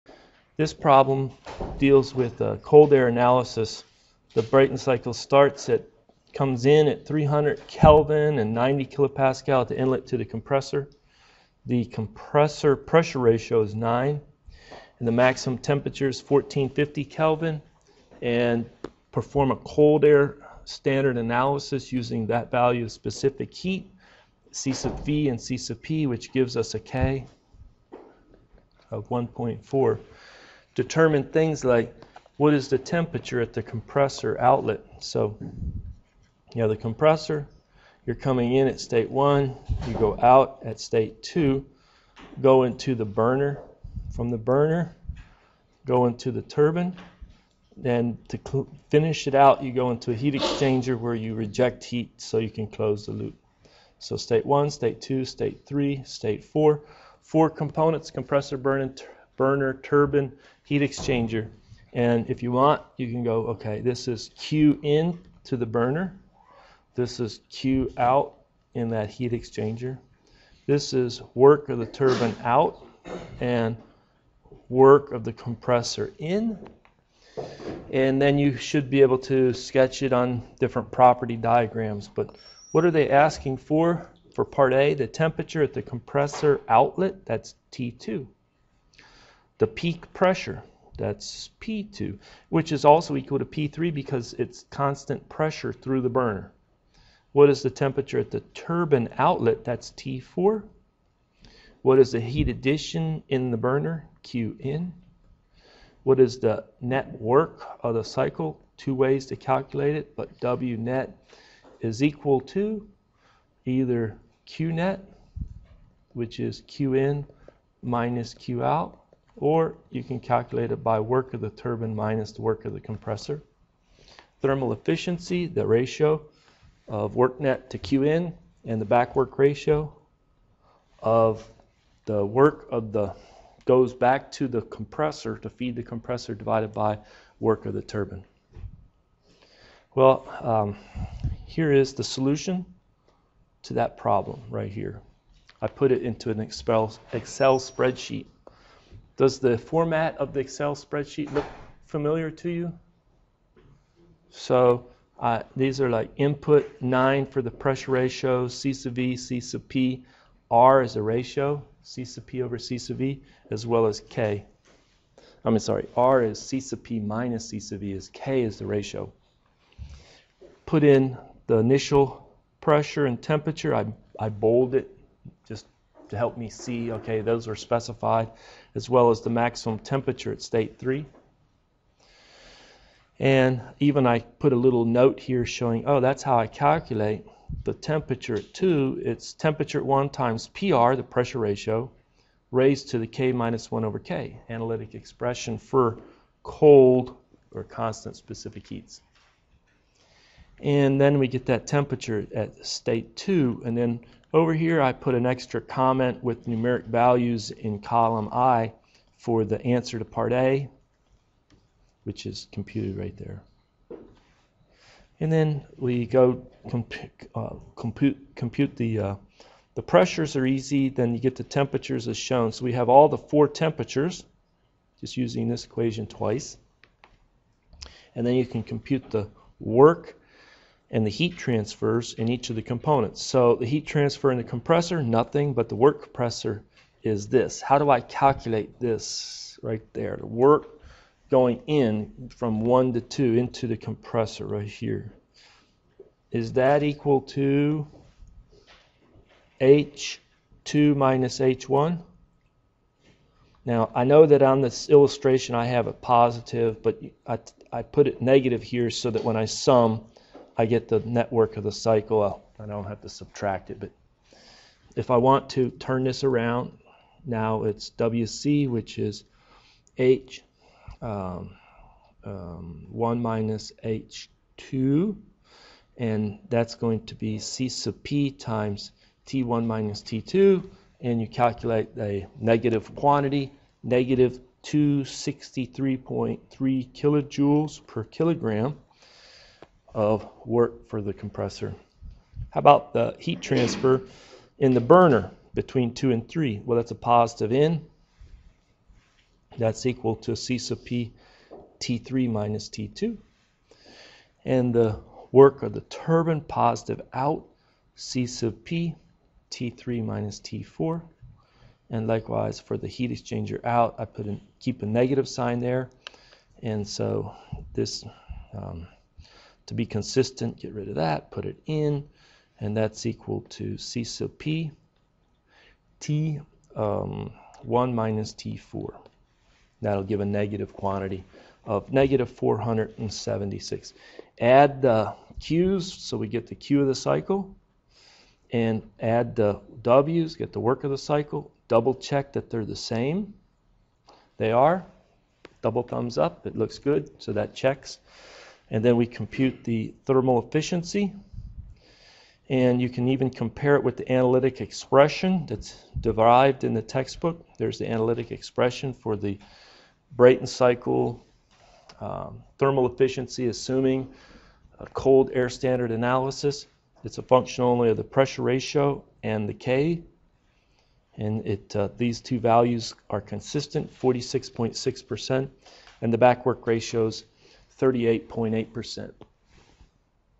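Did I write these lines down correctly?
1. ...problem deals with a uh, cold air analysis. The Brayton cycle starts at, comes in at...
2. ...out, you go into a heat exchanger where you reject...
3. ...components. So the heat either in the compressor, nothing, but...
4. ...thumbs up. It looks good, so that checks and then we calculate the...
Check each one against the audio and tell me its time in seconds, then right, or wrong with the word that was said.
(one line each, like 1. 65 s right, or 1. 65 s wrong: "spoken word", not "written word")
1. 0 s right
2. 49 s right
3. 232 s wrong: "transfer", not "either"
4. 345 s wrong: "compute", not "calculate".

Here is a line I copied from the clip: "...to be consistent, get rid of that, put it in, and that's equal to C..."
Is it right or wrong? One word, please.
right.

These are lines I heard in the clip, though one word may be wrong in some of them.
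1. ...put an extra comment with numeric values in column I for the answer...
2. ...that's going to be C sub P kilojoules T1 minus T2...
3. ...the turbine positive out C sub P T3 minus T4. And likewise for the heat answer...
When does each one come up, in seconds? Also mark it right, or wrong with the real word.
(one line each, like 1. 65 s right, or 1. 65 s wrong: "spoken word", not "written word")
1. 204 s right
2. 276 s wrong: "times", not "kilojoules"
3. 305 s wrong: "exchanger", not "answer".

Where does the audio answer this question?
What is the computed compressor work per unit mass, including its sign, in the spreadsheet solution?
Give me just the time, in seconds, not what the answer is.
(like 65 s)
283 s.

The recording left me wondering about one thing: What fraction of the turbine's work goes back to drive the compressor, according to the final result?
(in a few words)
38.8%.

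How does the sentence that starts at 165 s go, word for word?
I mean, sorry, R is C sub P minus C sub V is K is the ratio.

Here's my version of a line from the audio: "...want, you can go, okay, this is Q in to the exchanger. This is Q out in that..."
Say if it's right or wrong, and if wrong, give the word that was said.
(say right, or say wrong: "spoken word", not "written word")
wrong: "burner", not "exchanger".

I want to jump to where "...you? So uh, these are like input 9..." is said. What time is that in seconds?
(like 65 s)
152 s.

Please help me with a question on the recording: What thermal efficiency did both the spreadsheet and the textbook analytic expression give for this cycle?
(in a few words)
46.6%.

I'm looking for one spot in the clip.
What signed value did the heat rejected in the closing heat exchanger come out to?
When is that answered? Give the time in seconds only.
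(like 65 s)
331 s.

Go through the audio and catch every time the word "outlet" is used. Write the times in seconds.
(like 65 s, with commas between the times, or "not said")
34 s, 86 s, 99 s.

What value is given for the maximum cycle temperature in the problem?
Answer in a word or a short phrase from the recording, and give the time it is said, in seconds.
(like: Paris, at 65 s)
1450 K, at 16 s.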